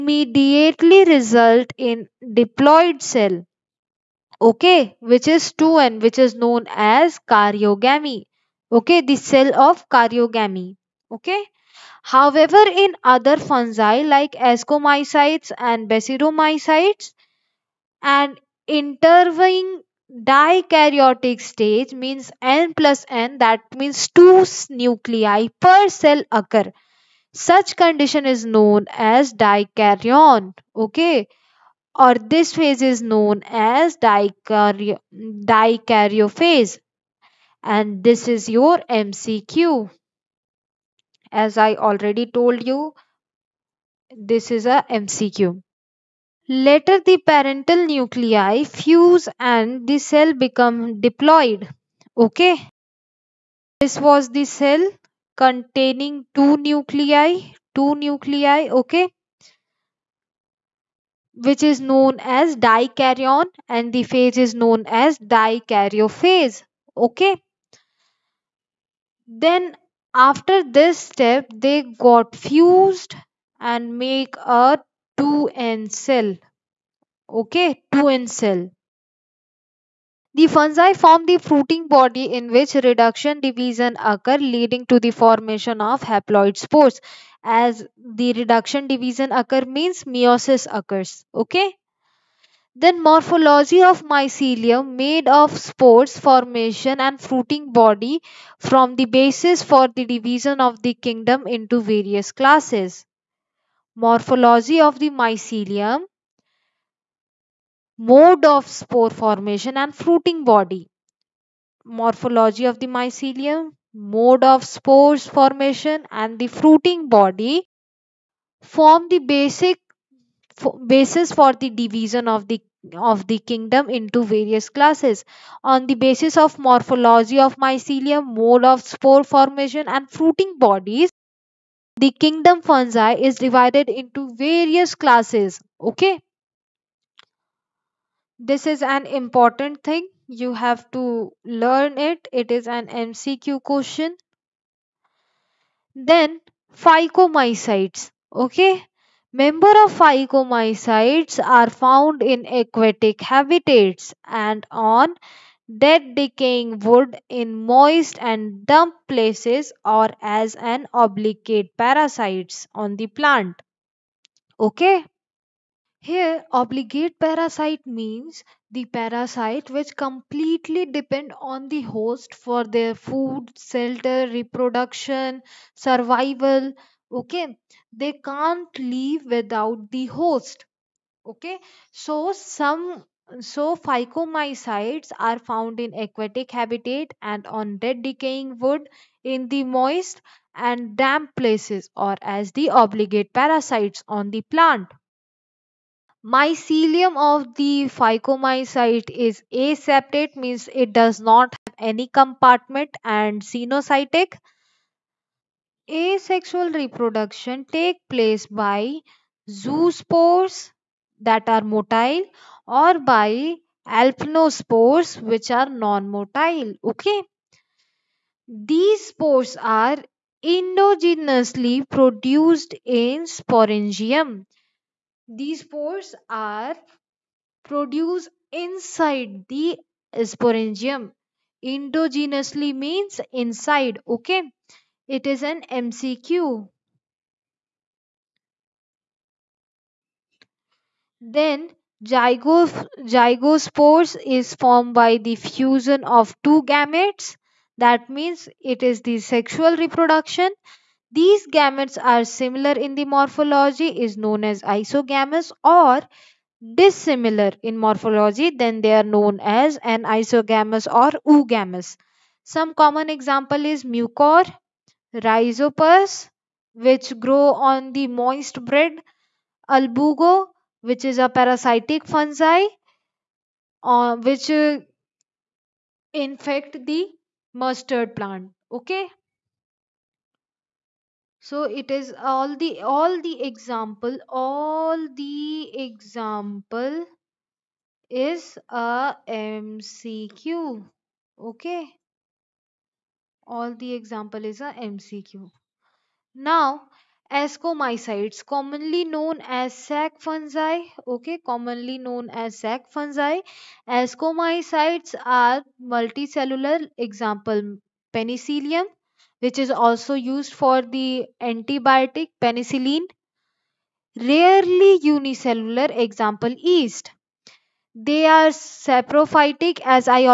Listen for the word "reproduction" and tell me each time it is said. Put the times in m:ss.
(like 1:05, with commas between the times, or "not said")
2:54, 3:26, 4:09.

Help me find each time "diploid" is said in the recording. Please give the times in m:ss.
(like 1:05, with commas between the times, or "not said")
0:02, 0:51.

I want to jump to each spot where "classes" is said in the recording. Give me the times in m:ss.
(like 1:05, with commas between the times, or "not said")
1:42, 2:04, 2:14.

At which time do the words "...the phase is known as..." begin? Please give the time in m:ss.
1:03.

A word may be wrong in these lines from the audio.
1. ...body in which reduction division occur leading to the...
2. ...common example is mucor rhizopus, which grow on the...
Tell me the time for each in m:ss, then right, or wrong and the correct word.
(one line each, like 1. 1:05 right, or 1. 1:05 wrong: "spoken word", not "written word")
1. 1:21 right
2. 4:22 right.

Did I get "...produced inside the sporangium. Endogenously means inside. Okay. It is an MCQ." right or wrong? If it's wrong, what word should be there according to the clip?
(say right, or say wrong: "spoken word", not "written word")
right.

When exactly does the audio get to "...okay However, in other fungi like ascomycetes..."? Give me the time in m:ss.
0:11.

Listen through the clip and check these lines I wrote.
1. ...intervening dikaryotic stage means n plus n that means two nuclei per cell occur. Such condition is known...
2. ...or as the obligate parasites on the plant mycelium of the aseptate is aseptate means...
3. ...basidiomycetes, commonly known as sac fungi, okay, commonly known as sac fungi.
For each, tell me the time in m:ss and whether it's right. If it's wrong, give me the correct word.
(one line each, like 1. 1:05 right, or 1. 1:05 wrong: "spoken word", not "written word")
1. 0:18 right
2. 3:11 wrong: "phycomycete", not "aseptate"
3. 4:57 wrong: "ascomycetes", not "basidiomycetes".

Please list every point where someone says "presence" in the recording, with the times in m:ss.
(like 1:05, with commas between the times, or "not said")
not said.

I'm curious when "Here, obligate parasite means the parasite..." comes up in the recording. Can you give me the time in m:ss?
2:45.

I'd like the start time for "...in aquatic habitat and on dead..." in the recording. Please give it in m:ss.
3:05.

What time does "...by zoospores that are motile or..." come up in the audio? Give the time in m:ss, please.
3:28.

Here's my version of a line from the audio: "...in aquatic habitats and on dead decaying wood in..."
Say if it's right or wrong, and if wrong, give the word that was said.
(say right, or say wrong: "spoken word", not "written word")
right.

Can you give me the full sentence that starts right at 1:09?
Then after this step, they got fused and make a 2n cell.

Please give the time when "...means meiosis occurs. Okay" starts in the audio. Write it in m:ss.
1:29.